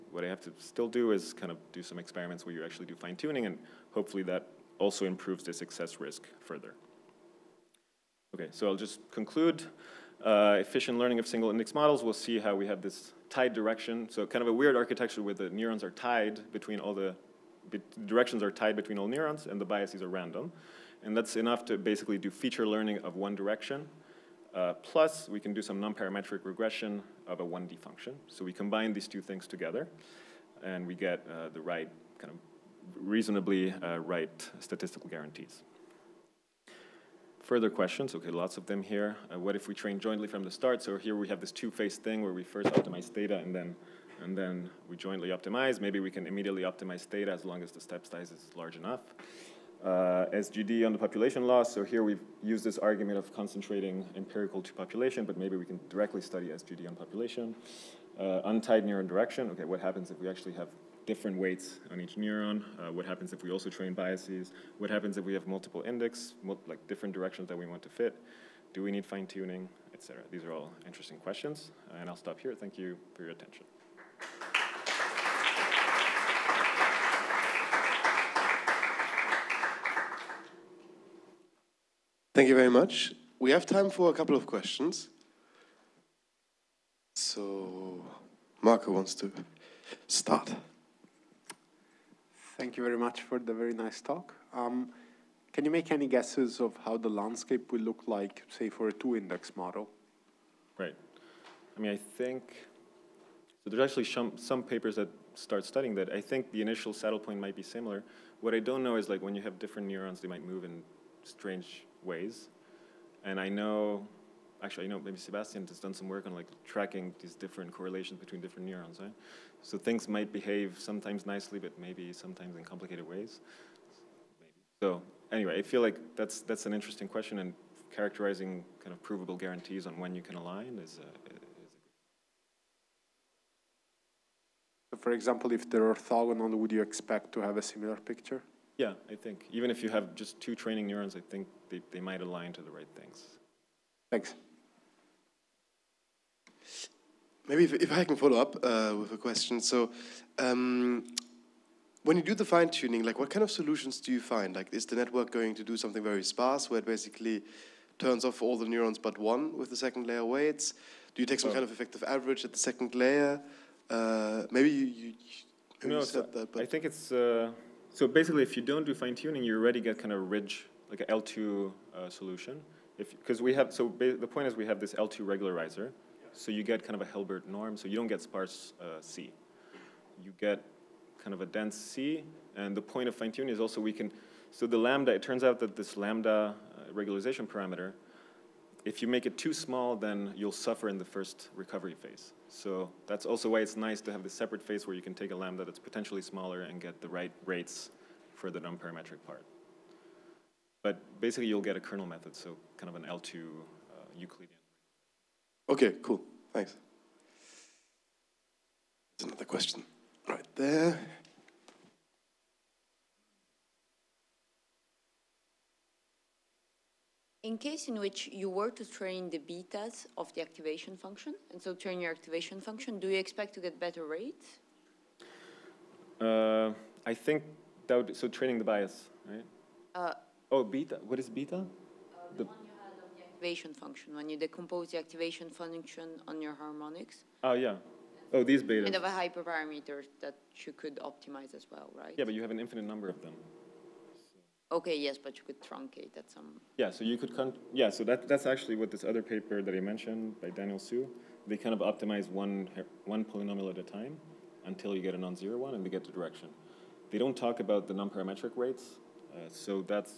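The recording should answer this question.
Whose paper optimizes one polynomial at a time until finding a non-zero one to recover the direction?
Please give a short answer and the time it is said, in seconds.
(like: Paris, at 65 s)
Daniel Hsu, at 250 s.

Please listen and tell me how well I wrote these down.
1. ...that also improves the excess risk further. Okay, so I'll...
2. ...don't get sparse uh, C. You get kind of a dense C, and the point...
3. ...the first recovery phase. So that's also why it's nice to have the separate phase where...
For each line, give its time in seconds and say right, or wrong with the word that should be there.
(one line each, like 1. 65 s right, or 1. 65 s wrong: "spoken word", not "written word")
1. 4 s right
2. 177 s right
3. 190 s right.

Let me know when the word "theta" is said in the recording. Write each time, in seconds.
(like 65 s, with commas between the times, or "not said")
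43 s, 47 s.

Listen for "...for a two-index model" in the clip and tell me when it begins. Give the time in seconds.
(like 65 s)
98 s.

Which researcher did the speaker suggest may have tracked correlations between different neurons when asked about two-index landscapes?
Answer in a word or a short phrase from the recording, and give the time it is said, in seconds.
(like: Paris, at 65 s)
Sebastian, at 115 s.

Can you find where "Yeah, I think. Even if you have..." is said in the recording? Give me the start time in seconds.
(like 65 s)
138 s.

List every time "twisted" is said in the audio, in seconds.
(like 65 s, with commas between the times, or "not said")
not said.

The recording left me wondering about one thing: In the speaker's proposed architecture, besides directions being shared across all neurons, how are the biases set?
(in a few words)
Random.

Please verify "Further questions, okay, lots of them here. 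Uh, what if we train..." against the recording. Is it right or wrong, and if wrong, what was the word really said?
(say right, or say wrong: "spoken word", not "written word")
right.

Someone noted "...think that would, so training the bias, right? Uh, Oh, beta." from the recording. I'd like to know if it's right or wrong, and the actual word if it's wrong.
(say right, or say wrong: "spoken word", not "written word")
right.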